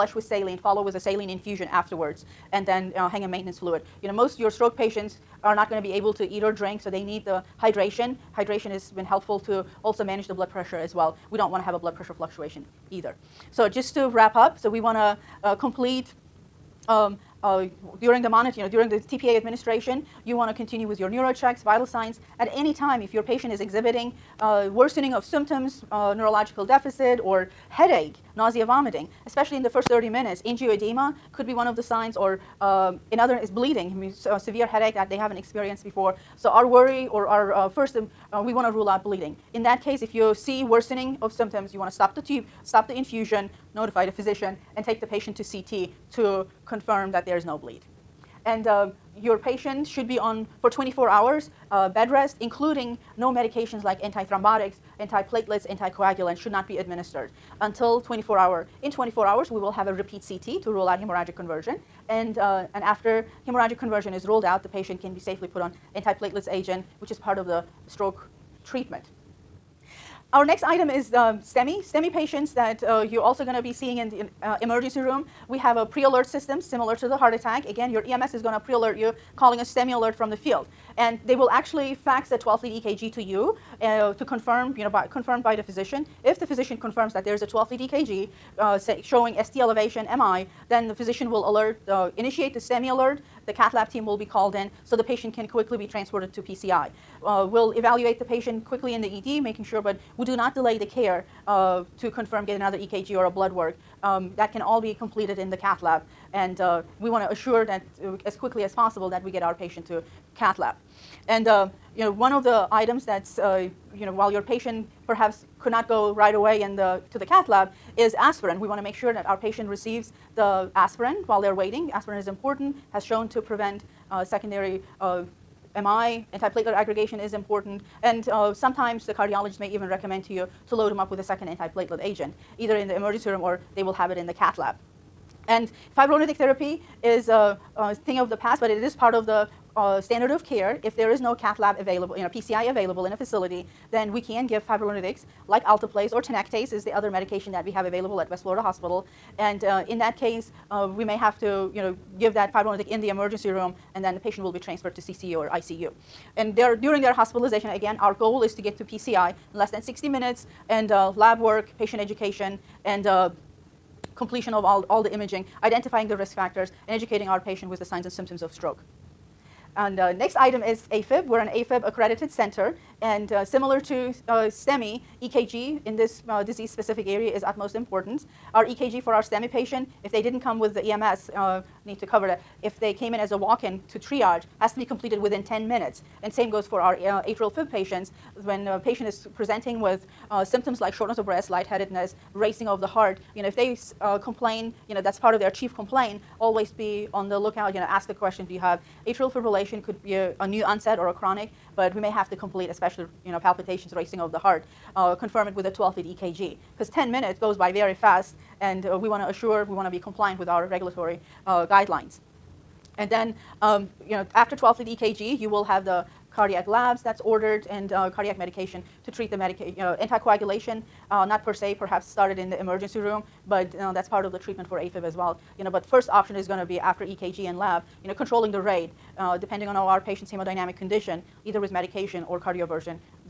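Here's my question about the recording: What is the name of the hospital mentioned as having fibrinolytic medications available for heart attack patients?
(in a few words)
West Florida Hospital.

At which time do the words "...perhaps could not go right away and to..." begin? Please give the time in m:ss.
1:55.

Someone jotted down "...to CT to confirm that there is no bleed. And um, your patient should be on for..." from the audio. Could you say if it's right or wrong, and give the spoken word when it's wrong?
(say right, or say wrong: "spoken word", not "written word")
right.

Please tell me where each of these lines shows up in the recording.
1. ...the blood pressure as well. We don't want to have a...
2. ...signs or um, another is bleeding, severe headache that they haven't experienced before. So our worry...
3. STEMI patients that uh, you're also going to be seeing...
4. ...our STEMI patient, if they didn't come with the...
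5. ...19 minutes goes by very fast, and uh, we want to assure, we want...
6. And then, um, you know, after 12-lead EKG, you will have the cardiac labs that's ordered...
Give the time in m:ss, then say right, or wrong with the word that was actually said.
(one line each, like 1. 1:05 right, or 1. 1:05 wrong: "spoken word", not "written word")
1. 0:10 right
2. 0:31 right
3. 1:11 right
4. 2:59 right
5. 3:26 wrong: "10", not "19"
6. 3:32 right.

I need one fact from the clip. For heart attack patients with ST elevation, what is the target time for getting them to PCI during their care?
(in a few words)
less than 60 minutes.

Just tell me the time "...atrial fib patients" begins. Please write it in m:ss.
3:07.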